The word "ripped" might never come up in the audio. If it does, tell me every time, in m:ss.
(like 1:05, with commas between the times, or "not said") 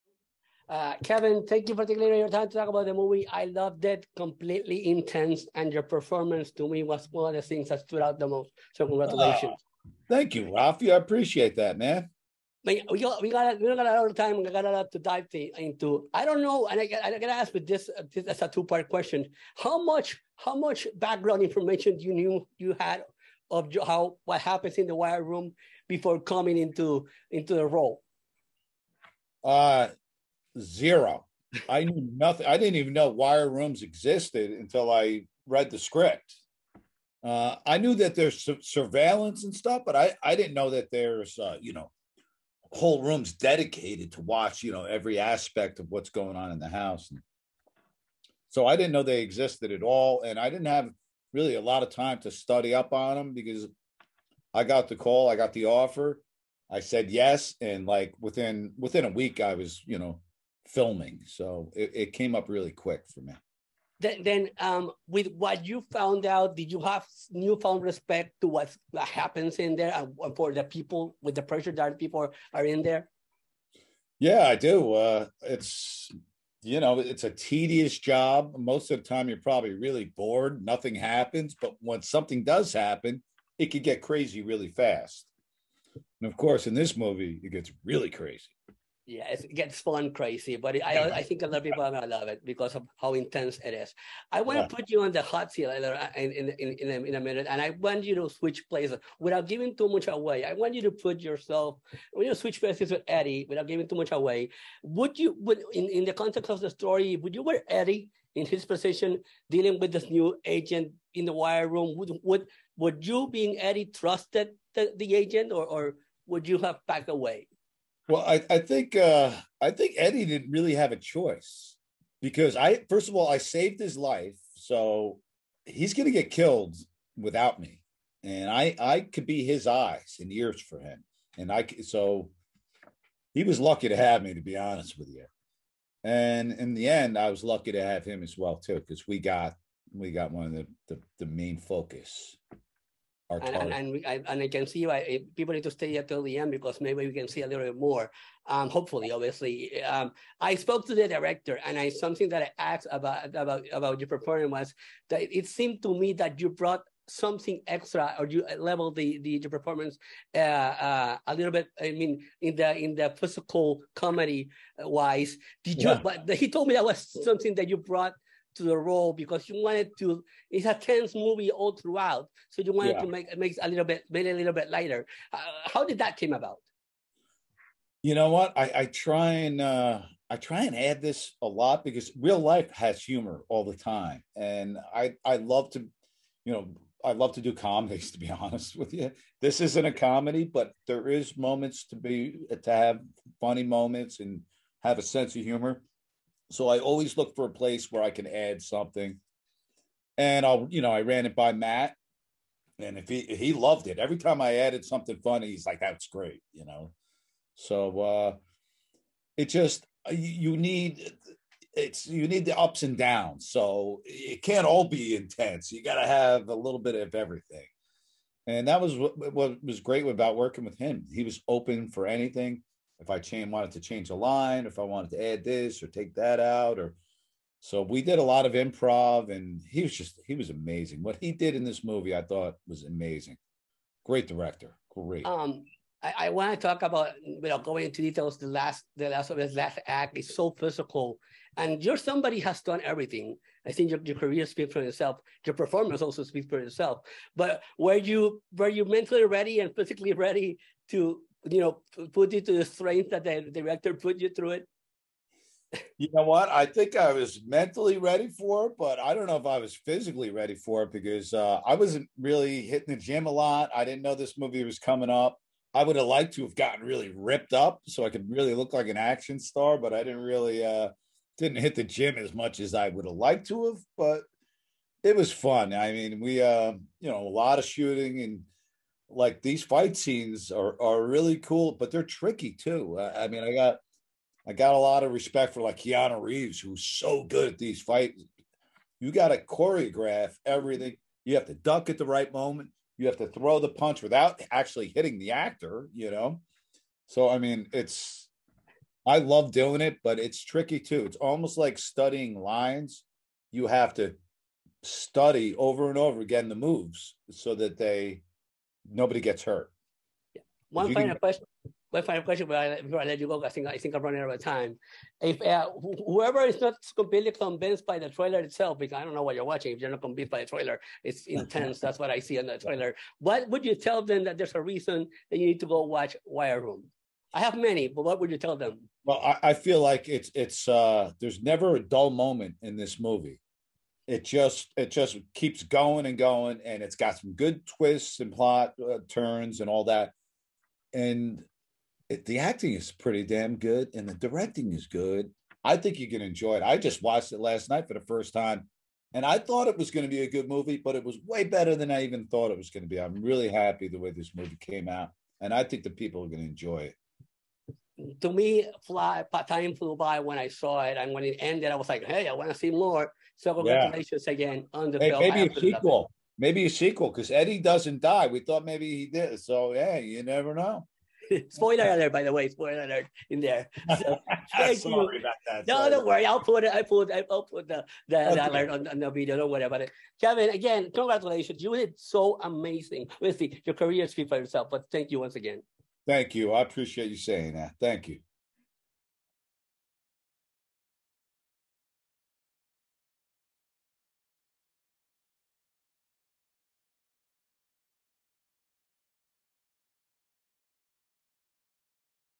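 4:27.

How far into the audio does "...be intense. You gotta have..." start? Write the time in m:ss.
3:34.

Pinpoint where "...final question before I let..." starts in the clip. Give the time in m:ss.
5:12.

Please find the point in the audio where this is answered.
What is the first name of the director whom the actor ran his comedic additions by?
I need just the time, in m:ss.
3:21.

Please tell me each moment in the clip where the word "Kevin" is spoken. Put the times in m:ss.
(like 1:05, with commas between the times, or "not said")
0:01, 6:20.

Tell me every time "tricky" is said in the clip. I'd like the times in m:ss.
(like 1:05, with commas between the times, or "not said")
4:42, 5:00.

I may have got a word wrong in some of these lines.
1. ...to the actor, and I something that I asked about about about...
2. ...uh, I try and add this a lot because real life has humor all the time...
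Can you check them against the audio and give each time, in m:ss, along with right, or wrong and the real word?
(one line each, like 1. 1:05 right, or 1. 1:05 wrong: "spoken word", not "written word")
1. 2:30 wrong: "director", not "actor"
2. 2:59 right.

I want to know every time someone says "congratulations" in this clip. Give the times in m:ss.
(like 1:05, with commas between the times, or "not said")
0:08, 6:03, 6:20.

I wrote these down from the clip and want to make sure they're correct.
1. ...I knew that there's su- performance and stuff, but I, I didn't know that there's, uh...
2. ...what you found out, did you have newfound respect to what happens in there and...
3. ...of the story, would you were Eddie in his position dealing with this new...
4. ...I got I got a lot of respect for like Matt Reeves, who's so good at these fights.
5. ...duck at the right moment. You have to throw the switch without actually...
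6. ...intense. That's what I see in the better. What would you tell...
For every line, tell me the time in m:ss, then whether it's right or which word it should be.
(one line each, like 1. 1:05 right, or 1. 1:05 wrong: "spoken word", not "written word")
1. 0:37 wrong: "surveillance", not "performance"
2. 1:05 right
3. 1:46 right
4. 4:43 wrong: "Keanu", not "Matt"
5. 4:51 wrong: "punch", not "switch"
6. 5:21 wrong: "trailer", not "better".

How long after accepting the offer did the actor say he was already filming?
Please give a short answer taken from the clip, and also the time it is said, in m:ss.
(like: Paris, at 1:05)
within a week, at 0:58.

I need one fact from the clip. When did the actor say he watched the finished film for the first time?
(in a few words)
last night.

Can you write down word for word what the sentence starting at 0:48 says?
So I didn't know they existed at all.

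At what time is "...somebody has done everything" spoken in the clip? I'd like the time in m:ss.
4:01.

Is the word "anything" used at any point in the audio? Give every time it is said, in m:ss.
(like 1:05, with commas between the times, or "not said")
3:42.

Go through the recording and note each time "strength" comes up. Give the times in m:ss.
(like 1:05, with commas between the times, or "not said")
4:12.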